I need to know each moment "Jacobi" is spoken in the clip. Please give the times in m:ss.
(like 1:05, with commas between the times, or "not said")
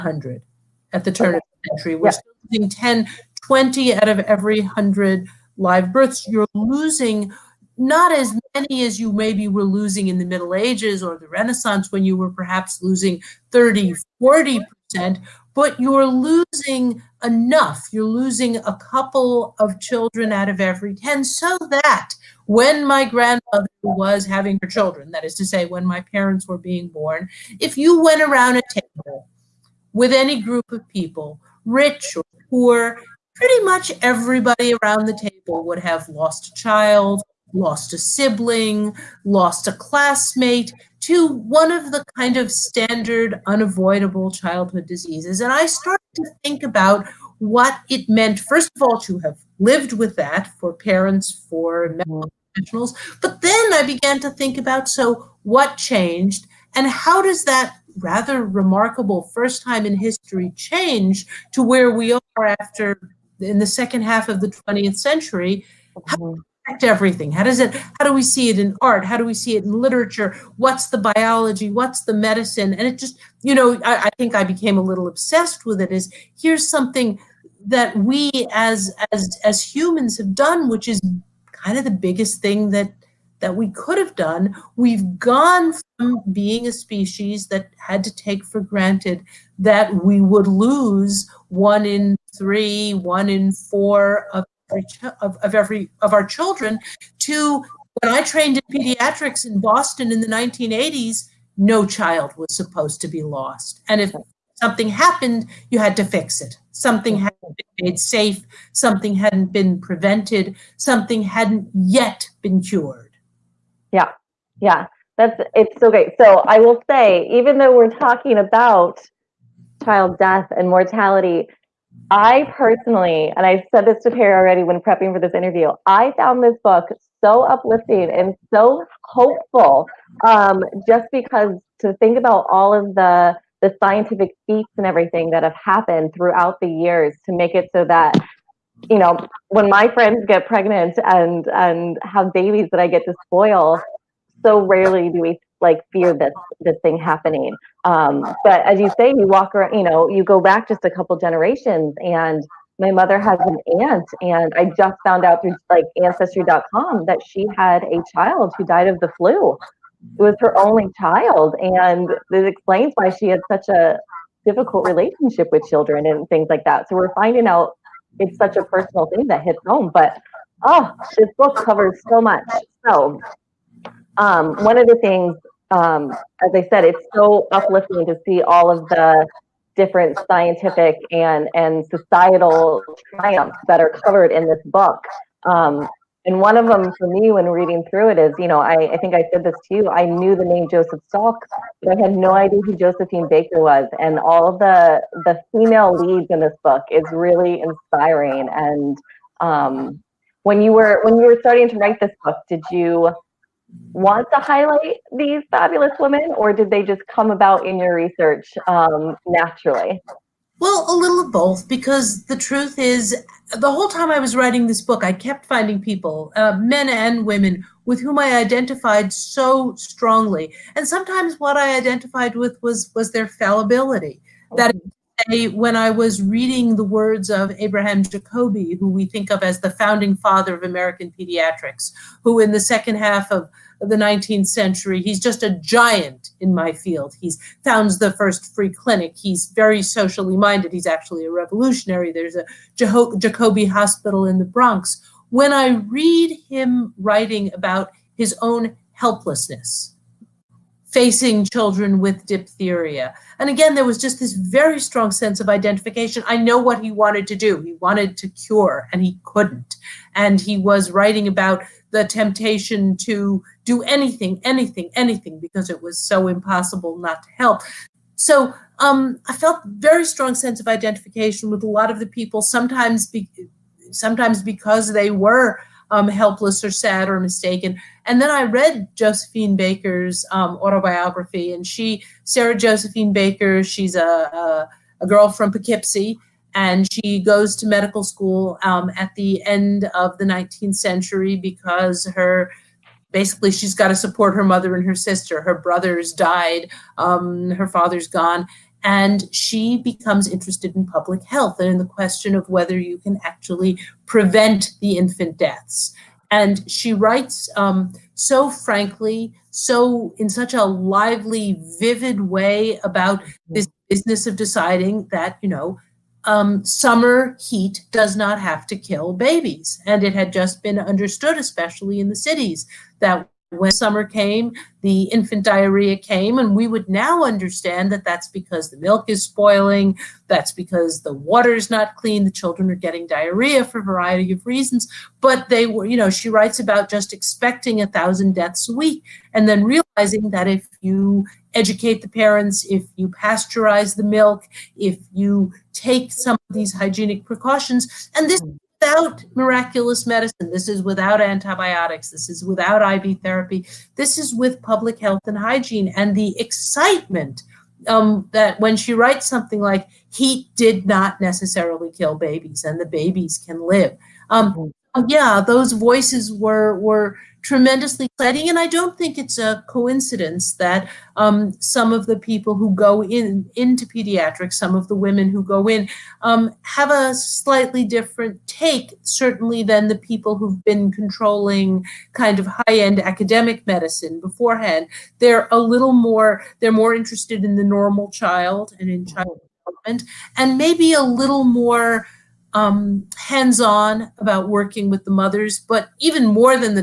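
3:48, 4:03.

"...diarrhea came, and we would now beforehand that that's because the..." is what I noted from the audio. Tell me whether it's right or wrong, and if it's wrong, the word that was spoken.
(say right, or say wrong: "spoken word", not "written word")
wrong: "understand", not "beforehand".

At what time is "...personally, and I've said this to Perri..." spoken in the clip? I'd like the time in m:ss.
2:02.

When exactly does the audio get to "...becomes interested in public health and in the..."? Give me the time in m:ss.
4:59.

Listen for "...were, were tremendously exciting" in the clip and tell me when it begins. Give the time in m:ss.
6:06.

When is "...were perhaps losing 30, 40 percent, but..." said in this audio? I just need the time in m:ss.
0:12.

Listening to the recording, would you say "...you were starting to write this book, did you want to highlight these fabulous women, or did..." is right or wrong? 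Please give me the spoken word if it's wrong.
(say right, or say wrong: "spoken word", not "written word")
right.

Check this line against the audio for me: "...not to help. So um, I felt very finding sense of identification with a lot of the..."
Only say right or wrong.
wrong.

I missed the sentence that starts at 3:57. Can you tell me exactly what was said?
He's founds the first free clinic.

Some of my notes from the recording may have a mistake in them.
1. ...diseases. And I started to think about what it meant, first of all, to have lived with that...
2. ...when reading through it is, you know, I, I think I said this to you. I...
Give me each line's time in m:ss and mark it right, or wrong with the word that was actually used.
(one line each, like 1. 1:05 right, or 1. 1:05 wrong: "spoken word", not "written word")
1. 0:44 right
2. 3:07 right.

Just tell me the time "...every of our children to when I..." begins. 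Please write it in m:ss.
1:35.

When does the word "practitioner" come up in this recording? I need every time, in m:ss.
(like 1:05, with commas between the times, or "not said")
not said.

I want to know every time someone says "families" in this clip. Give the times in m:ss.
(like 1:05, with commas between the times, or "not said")
not said.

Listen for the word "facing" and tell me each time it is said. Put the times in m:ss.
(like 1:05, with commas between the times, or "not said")
4:10.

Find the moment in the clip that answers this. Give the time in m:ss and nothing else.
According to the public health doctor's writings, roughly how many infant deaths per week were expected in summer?
5:37.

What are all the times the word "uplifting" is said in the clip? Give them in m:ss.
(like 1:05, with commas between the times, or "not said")
2:07, 2:57.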